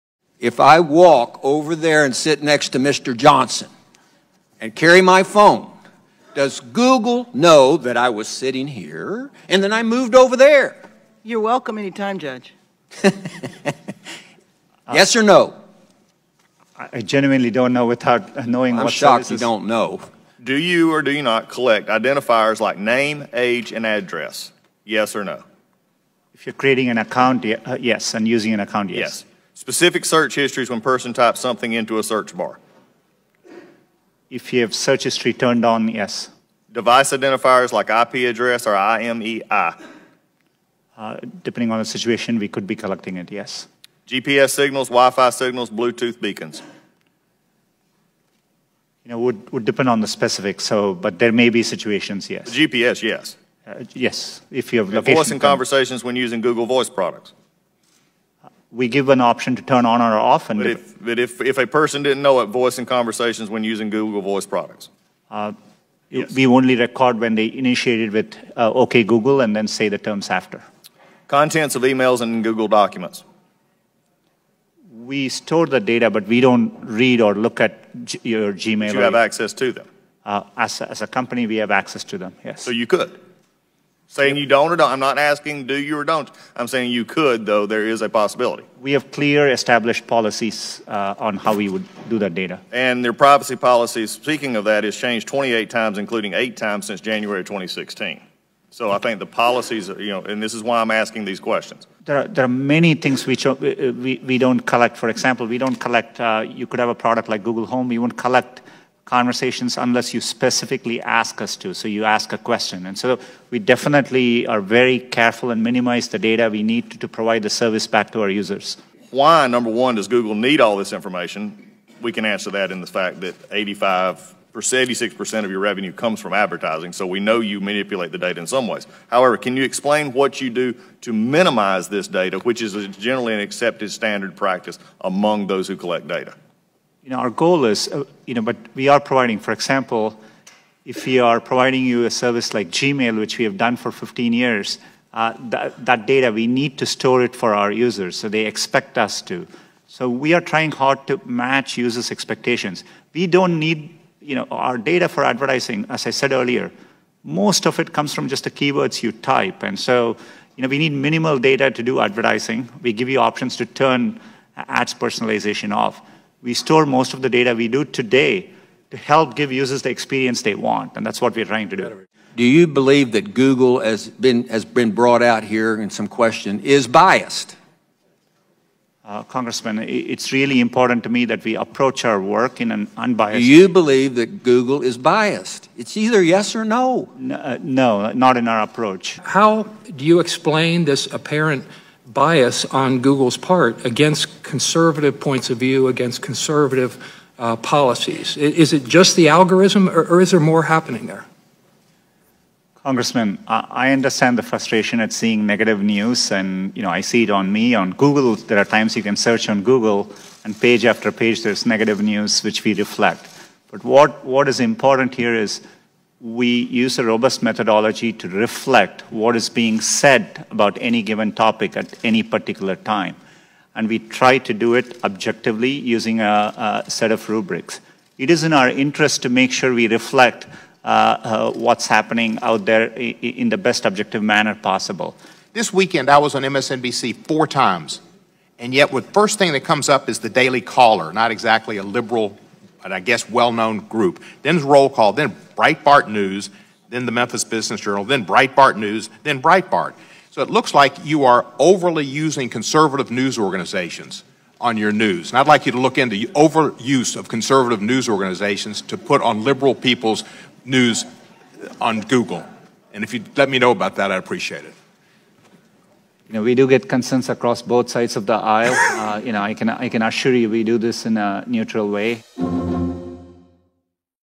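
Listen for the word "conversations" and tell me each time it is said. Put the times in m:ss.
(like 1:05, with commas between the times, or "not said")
0:55, 1:02, 1:49.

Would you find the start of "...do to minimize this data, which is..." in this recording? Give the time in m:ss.
2:10.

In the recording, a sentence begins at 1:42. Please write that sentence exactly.
There are, there are many things which we, uh, we, we don't collect.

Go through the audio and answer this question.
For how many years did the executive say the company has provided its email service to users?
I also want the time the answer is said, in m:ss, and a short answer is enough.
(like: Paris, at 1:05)
15, at 2:23.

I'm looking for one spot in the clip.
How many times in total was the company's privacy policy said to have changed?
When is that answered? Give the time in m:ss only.
1:35.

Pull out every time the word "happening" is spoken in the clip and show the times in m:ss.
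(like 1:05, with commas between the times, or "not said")
3:20, 3:51.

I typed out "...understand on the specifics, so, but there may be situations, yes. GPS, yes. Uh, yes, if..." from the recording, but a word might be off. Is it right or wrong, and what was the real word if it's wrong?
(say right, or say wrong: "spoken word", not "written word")
wrong: "depend", not "understand".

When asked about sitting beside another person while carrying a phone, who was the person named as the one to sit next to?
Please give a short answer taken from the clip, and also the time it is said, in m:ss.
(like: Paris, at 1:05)
Mr. Johnson, at 0:02.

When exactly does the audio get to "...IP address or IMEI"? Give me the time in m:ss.
0:37.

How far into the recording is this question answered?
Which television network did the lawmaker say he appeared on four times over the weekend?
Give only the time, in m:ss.
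3:56.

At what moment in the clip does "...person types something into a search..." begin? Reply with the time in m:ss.
0:30.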